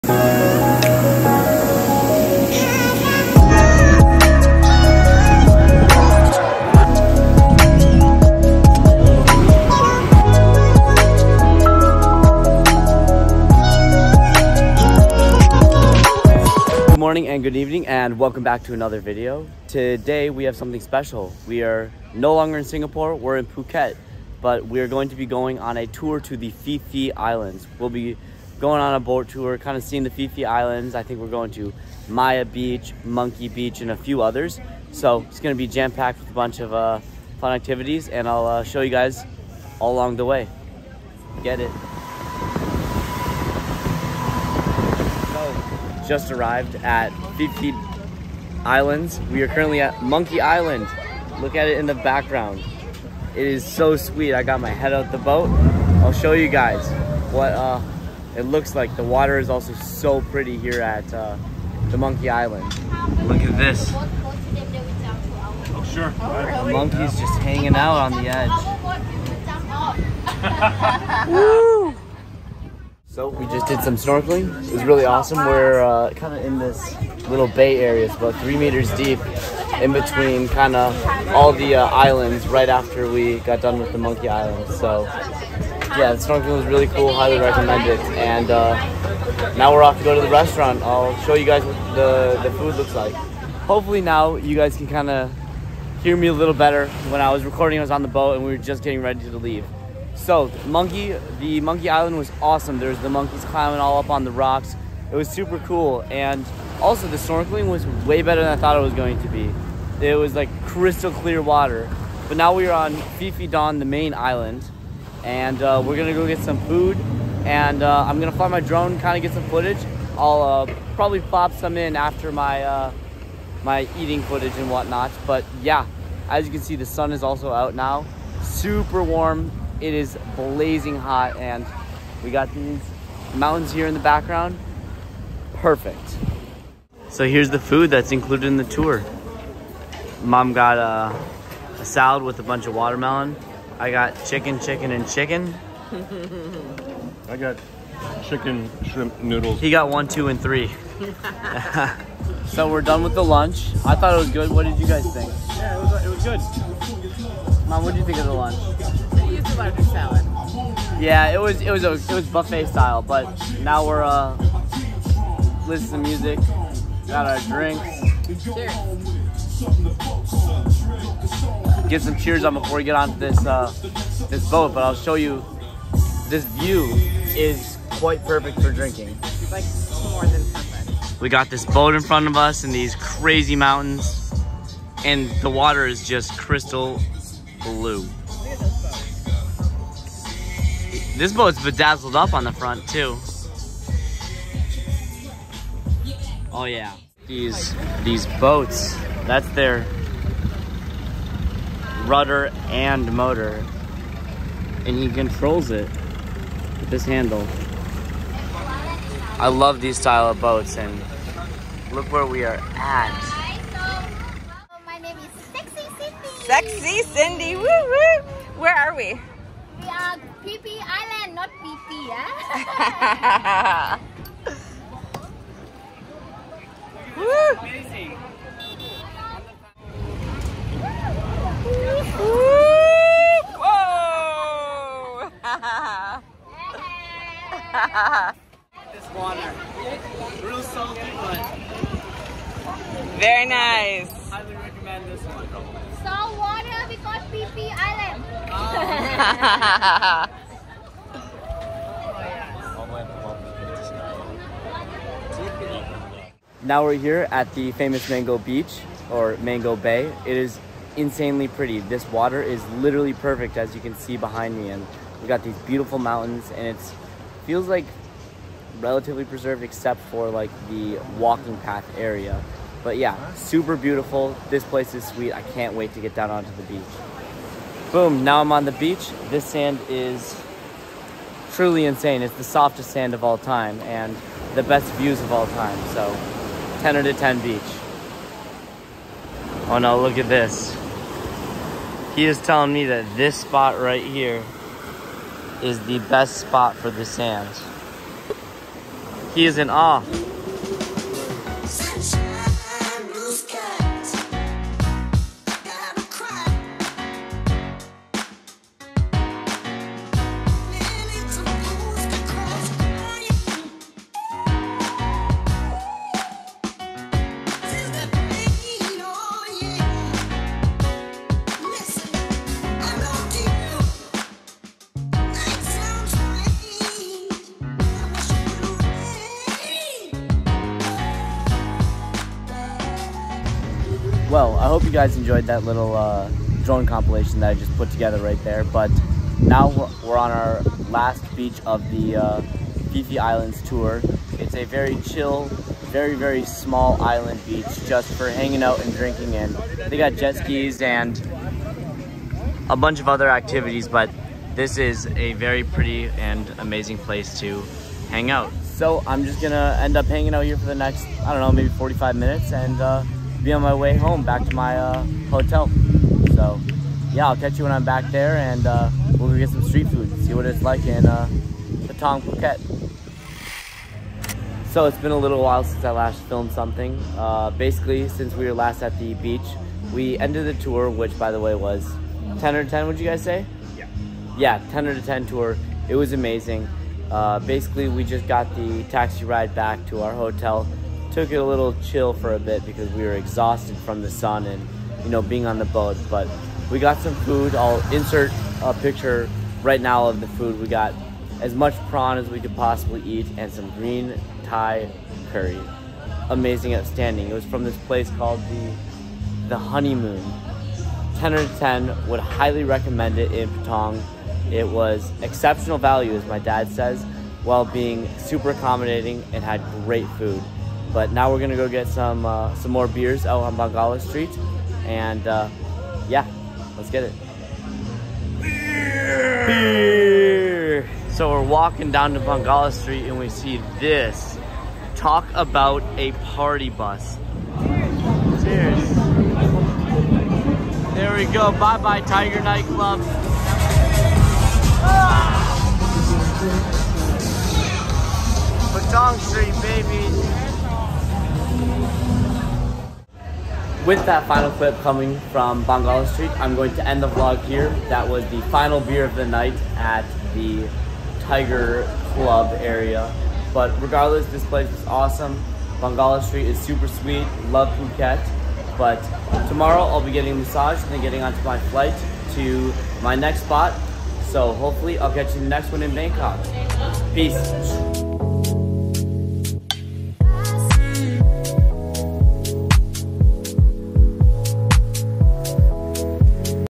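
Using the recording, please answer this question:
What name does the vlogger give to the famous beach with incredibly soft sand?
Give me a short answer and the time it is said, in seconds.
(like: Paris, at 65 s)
Mango Beach, at 258 s.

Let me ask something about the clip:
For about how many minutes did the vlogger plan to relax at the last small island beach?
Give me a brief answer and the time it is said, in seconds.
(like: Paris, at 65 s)
45 minutes, at 361 s.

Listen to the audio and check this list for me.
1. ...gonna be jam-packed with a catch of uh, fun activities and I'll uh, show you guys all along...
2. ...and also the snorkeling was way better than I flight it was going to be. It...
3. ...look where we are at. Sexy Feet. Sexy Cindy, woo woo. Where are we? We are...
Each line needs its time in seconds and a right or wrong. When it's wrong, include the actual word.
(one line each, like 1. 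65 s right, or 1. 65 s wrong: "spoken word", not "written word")
1. 35 s wrong: "bunch", not "catch"
2. 106 s wrong: "thought", not "flight"
3. 211 s wrong: "Cindy", not "Feet".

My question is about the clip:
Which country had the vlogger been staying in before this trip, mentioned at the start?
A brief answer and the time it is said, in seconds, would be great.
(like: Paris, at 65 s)
Singapore, at 22 s.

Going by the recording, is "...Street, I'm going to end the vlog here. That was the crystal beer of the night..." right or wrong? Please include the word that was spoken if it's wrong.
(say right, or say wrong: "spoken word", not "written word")
wrong: "final", not "crystal".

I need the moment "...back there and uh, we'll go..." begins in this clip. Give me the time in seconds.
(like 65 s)
367 s.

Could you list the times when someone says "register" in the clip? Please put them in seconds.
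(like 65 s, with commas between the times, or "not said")
not said.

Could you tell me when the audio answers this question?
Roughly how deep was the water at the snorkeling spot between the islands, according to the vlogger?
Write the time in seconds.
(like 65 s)
78 s.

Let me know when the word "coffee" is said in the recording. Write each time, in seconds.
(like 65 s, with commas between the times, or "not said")
not said.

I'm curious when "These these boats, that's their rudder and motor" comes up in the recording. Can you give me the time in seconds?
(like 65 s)
197 s.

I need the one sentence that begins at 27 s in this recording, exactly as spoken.
We'll be going on a boat tour, kind of seeing the Phi Phi Islands.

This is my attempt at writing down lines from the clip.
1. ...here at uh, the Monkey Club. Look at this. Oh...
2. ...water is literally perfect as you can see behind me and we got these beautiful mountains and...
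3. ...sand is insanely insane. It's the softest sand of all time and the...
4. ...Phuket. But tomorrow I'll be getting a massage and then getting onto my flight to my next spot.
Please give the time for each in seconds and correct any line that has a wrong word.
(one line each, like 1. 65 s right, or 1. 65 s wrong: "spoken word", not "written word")
1. 60 s wrong: "Island", not "Club"
2. 262 s right
3. 279 s wrong: "truly", not "insanely"
4. 467 s right.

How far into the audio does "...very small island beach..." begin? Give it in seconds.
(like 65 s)
346 s.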